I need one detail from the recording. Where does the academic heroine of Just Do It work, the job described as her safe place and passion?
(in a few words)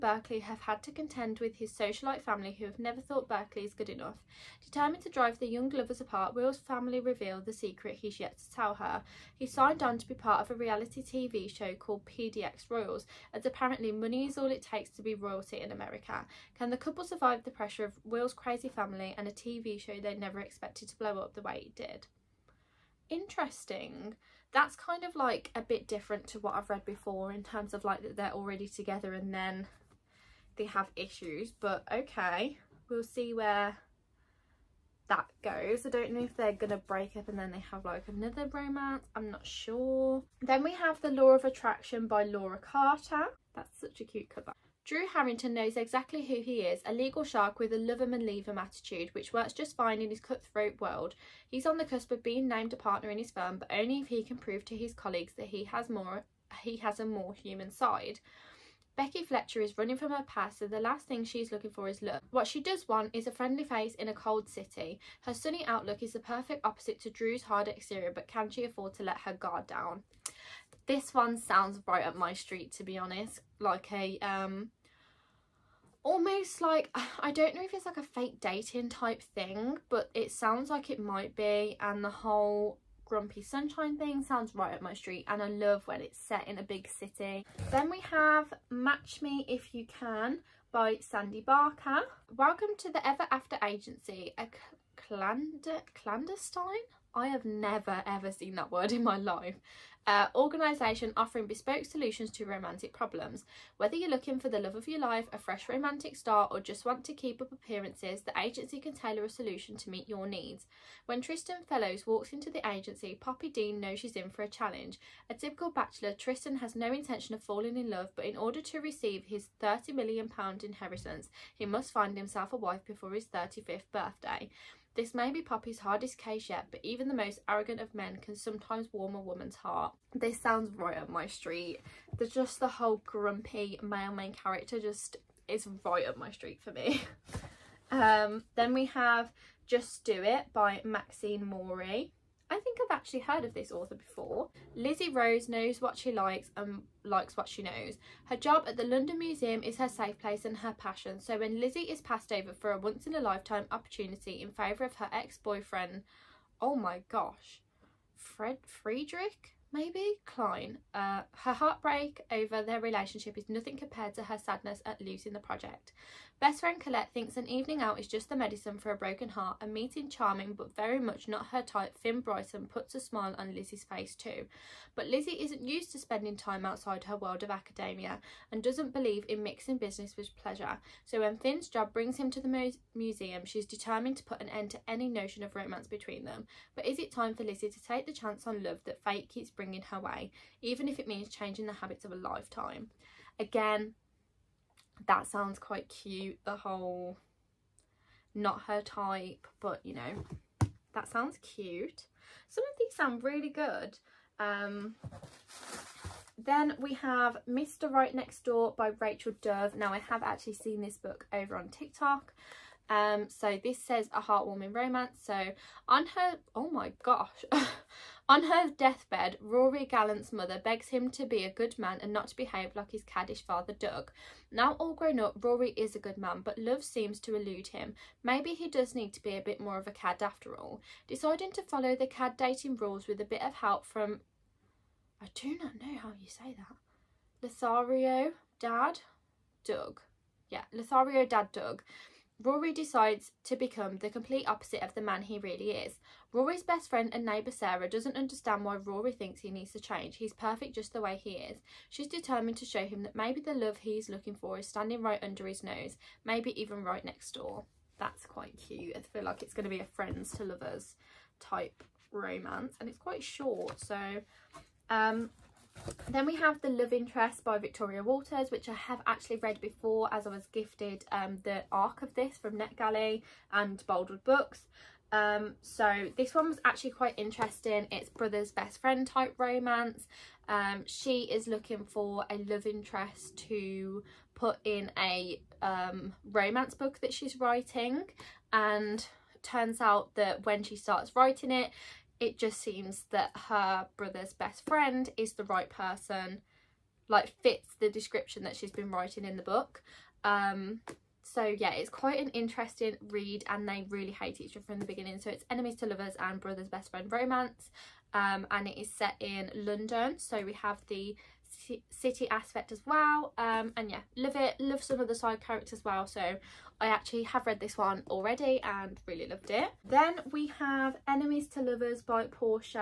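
London Museum.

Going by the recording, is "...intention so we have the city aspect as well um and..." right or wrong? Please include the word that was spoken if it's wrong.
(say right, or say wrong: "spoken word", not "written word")
wrong: "london", not "intention".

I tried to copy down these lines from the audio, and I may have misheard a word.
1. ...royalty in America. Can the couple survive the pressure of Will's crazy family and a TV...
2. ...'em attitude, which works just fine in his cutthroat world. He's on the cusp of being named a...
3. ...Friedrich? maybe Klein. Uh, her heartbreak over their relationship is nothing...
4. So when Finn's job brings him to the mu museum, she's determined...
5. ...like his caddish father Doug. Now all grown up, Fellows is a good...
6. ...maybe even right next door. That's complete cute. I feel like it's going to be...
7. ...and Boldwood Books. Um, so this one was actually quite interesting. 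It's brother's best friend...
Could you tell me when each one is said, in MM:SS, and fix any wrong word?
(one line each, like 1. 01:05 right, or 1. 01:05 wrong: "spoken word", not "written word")
1. 00:15 right
2. 00:48 right
3. 02:38 right
4. 03:01 right
5. 03:42 wrong: "Rory", not "Fellows"
6. 04:16 wrong: "quite", not "complete"
7. 04:33 right.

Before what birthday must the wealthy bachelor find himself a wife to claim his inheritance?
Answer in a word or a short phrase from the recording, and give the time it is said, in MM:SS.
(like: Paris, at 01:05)
35th, at 02:03.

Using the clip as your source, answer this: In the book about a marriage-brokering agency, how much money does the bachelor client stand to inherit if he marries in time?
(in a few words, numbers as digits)
£30 million.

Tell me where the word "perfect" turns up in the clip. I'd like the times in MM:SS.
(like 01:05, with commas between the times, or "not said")
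01:06, 04:10.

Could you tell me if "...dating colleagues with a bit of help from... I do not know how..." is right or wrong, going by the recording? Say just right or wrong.
wrong.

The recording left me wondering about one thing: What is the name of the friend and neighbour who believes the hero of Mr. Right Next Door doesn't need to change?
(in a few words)
Sarah.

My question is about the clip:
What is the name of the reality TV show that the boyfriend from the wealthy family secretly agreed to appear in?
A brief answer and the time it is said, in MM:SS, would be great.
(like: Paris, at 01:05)
PDX Royals, at 00:12.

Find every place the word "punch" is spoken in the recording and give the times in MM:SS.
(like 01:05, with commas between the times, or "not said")
not said.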